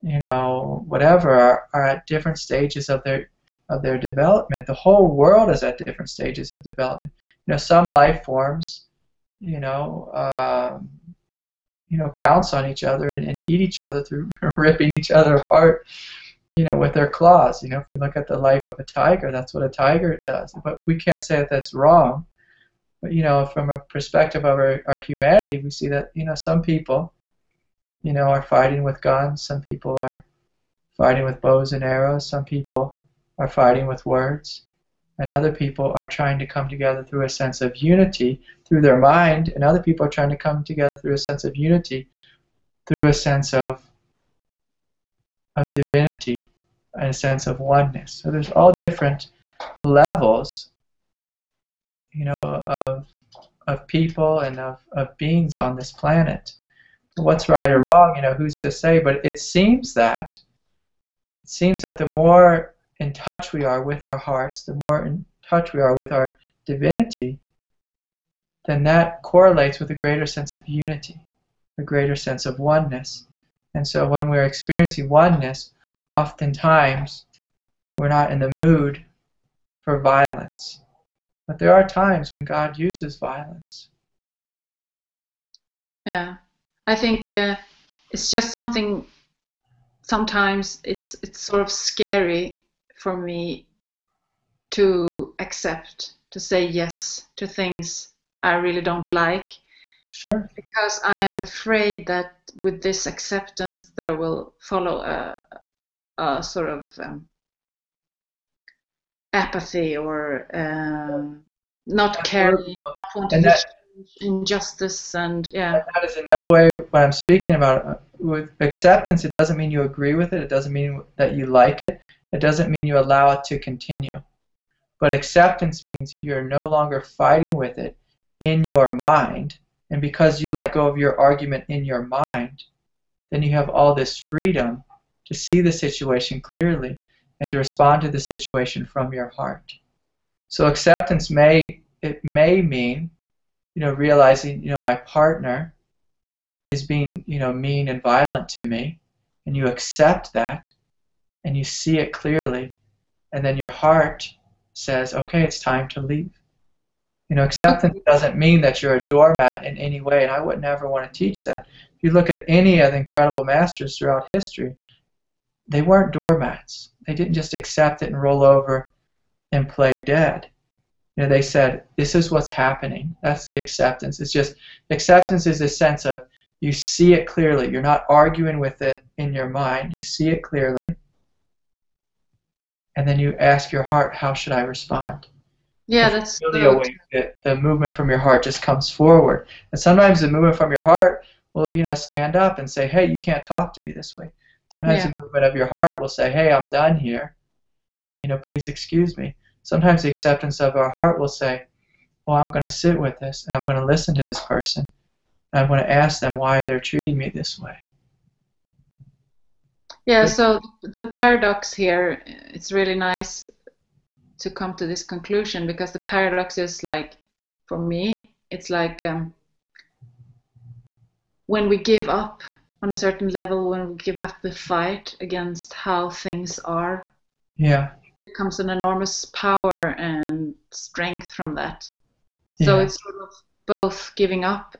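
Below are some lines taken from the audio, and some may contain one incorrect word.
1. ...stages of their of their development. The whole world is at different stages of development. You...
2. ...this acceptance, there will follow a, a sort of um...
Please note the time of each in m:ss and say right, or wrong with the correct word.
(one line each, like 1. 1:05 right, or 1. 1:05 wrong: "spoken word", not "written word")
1. 0:02 right
2. 1:42 right.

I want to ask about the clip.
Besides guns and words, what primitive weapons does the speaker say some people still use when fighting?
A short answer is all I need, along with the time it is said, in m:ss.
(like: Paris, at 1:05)
Bows and arrows, at 0:31.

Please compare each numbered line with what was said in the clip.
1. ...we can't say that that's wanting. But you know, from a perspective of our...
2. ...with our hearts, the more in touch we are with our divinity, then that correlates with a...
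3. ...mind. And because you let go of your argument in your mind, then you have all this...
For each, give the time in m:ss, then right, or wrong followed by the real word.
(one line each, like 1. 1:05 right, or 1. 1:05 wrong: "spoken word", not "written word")
1. 0:20 wrong: "wrong", not "wanting"
2. 1:03 right
3. 2:08 right.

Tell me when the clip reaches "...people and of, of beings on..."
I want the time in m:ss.
0:53.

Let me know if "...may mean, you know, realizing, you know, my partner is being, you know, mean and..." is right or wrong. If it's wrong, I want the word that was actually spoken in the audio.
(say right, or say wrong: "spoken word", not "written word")
right.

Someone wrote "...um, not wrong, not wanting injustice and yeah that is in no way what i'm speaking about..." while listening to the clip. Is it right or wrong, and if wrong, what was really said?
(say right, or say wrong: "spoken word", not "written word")
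wrong: "caring", not "wrong".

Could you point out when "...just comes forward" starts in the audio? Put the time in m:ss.
3:08.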